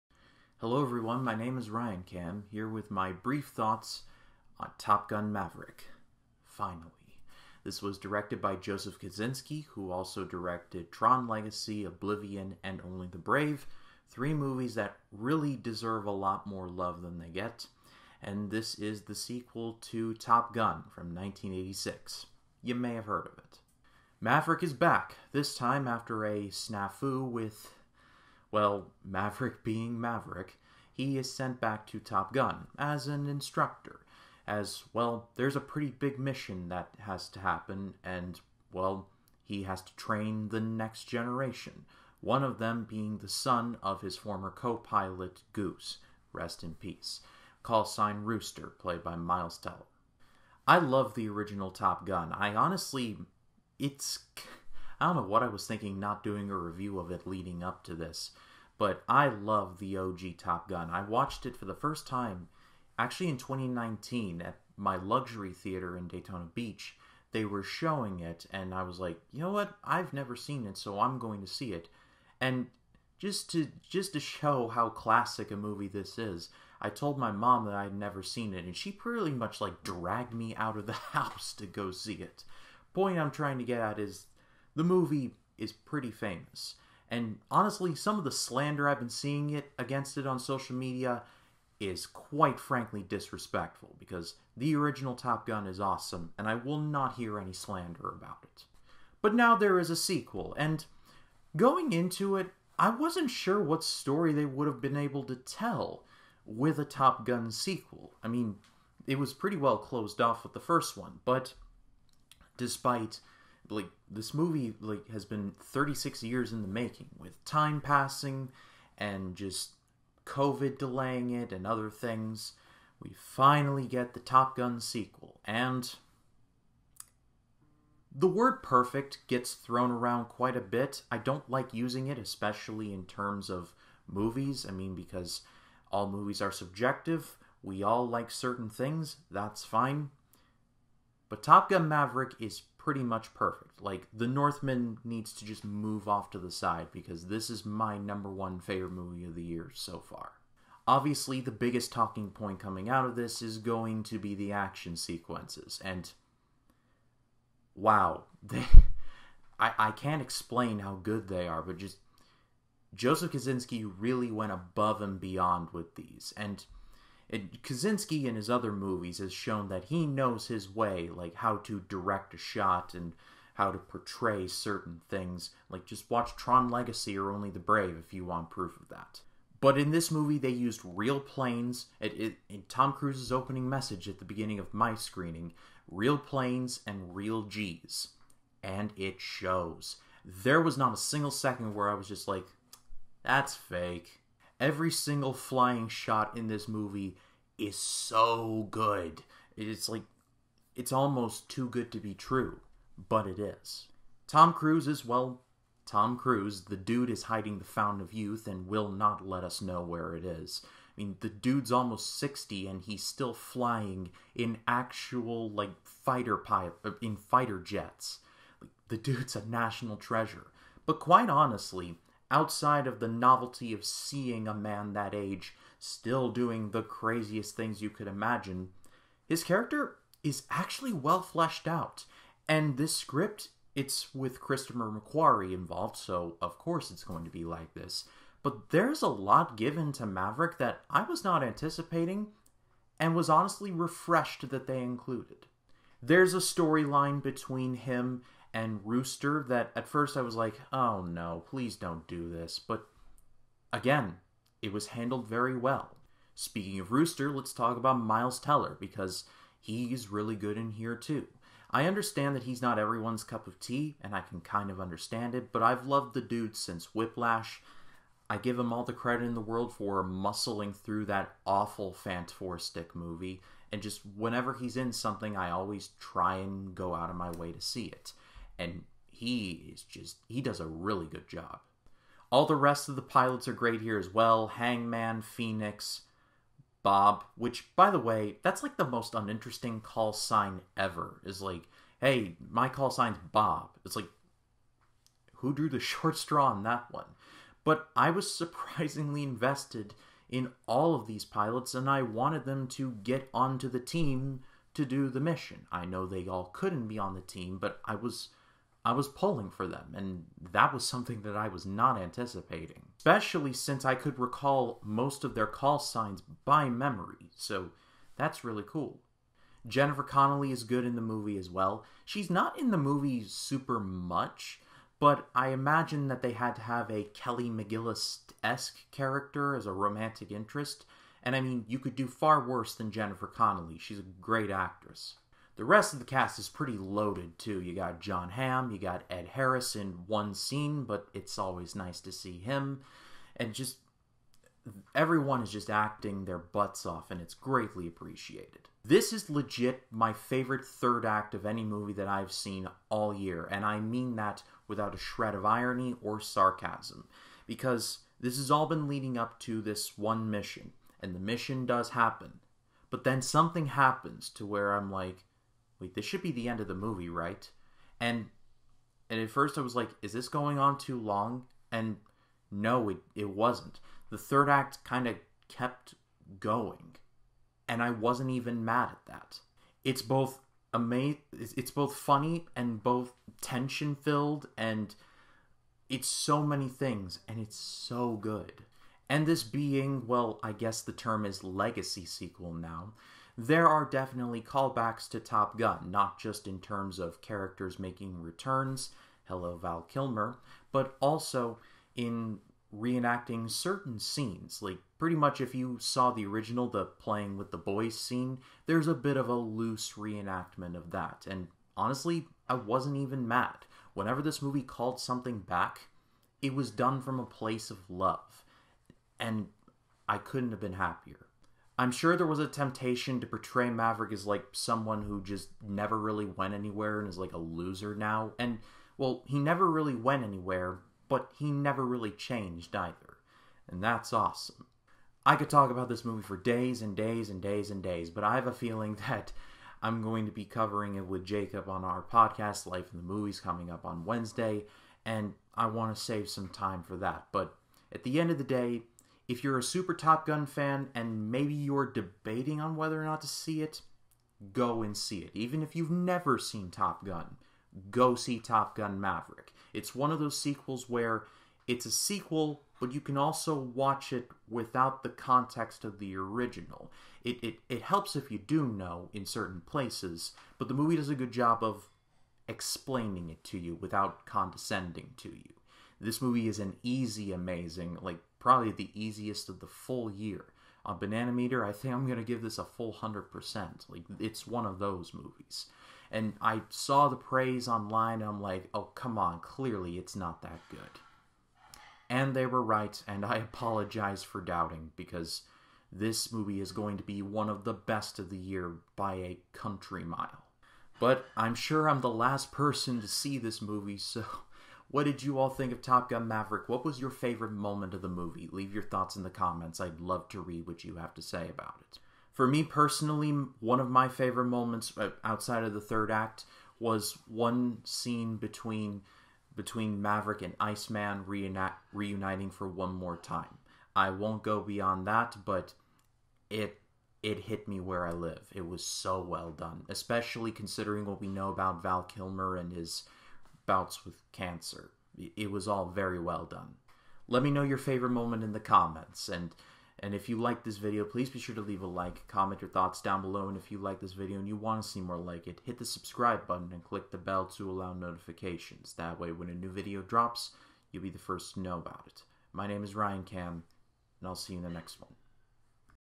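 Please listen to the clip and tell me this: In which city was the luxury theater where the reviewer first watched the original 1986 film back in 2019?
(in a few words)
Daytona Beach.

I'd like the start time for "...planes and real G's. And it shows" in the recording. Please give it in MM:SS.
03:06.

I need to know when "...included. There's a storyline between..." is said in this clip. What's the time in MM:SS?
04:04.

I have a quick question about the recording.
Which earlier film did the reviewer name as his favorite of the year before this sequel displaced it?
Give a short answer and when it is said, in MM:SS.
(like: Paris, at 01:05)
The Northman, at 02:24.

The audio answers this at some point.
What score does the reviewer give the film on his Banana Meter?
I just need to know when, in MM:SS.
08:02.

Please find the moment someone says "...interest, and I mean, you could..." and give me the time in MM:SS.
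05:30.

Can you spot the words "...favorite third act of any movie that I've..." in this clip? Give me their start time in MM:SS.
05:50.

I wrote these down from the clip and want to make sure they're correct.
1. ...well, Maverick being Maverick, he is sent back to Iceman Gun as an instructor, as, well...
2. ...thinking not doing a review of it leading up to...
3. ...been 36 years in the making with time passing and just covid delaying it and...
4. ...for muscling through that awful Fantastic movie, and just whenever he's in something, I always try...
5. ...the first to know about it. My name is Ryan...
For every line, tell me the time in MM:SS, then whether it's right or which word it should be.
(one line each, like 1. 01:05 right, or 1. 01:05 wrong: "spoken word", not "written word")
1. 00:28 wrong: "Top", not "Iceman"
2. 00:55 right
3. 01:55 right
4. 04:29 right
5. 09:11 right.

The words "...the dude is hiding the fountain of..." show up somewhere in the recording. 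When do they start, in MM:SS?
03:26.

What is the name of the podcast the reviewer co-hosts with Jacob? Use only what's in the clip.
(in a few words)
Life in the Movies.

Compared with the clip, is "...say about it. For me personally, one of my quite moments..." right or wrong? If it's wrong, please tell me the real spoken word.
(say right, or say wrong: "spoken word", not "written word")
wrong: "favorite", not "quite".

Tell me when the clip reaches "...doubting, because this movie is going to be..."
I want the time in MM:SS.
08:14.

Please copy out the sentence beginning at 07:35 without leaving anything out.
Even if you've never seen Top Gun, go see Top Gun Maverick.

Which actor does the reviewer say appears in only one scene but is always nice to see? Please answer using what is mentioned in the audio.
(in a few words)
Ed Harris.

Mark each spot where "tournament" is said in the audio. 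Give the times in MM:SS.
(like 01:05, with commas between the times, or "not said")
not said.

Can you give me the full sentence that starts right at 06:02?
But then something happens to where I'm like, Wait, this should be the end of the movie, right?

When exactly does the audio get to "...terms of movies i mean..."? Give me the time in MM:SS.
02:13.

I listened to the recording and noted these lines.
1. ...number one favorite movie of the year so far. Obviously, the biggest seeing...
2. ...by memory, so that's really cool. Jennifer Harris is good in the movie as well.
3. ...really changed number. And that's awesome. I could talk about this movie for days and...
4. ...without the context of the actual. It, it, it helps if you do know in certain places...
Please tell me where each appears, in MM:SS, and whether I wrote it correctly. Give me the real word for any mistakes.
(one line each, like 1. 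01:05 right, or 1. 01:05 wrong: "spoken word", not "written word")
1. 02:27 wrong: "talking", not "seeing"
2. 05:16 wrong: "Connelly", not "Harris"
3. 07:11 wrong: "either", not "number"
4. 07:44 wrong: "original", not "actual".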